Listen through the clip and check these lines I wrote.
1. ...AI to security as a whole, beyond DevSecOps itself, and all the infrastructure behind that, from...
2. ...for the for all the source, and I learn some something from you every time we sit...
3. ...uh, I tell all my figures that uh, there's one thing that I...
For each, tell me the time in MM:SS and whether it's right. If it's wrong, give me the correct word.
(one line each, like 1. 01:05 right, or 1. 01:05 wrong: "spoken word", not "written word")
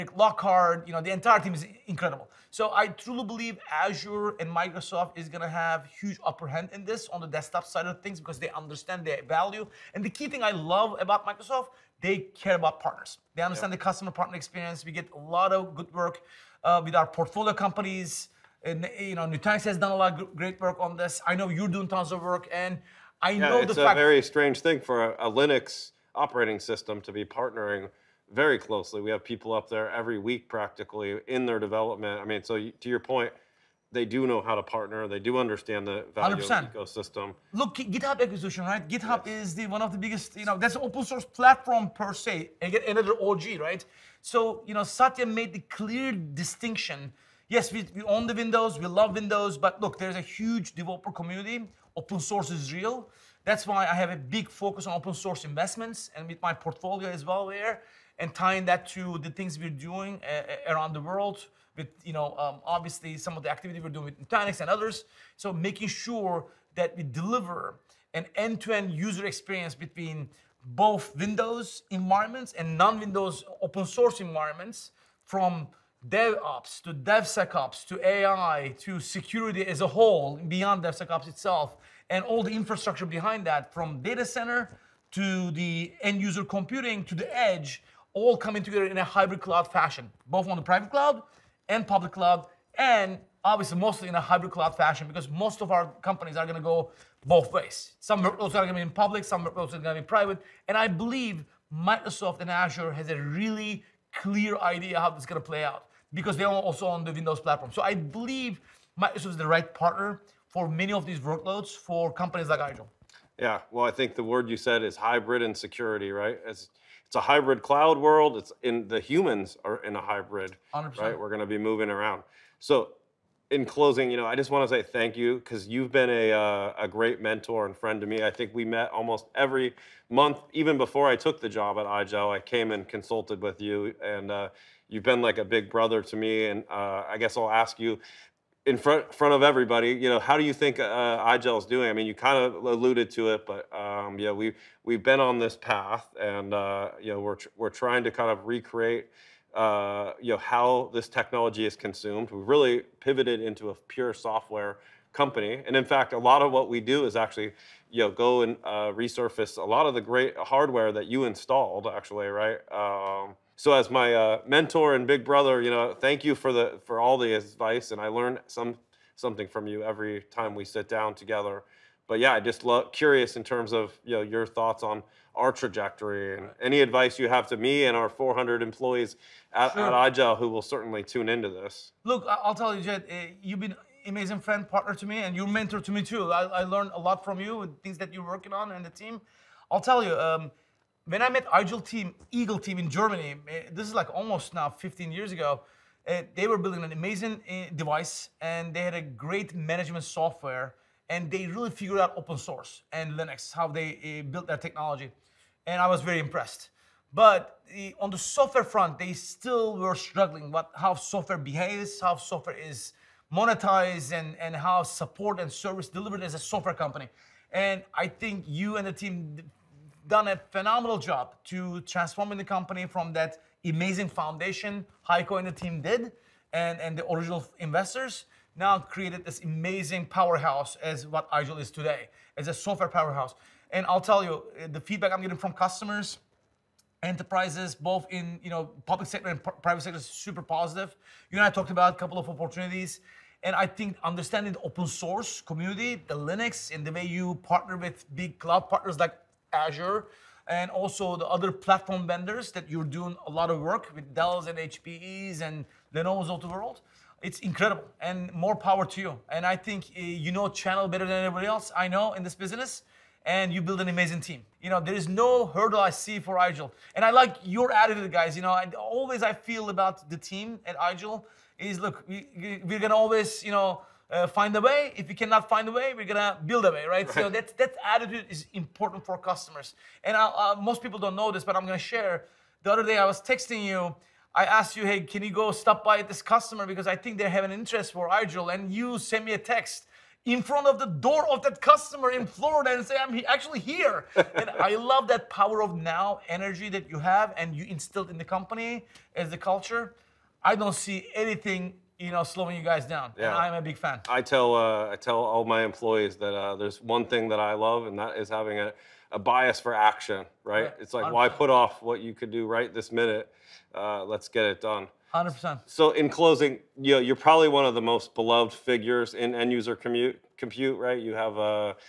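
1. 01:18 right
2. 02:46 wrong: "advice", not "source"
3. 05:04 wrong: "employees", not "figures".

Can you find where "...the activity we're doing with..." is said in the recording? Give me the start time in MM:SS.
01:03.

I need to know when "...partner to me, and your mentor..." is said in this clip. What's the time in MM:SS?
03:04.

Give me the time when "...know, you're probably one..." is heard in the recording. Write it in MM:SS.
05:16.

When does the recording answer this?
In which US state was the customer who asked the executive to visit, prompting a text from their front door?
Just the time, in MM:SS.
04:52.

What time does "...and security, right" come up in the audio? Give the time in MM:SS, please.
01:55.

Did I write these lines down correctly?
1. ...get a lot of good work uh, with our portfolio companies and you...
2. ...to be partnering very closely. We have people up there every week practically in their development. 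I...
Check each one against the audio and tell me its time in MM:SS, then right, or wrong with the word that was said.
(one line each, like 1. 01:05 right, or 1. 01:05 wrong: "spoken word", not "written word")
1. 00:14 right
2. 00:27 right.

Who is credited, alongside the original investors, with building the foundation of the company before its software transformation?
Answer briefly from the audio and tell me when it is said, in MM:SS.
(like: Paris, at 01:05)
Heiko, at 03:45.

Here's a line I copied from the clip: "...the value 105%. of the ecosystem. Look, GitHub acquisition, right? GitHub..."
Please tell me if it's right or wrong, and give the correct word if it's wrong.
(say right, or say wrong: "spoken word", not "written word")
wrong: "100", not "105".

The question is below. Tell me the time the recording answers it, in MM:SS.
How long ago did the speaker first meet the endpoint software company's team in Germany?
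03:14.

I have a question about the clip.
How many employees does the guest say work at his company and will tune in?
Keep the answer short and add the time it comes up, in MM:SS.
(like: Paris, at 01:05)
400, at 02:58.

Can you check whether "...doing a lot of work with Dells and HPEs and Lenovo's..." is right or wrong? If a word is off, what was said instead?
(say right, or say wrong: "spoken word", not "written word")
right.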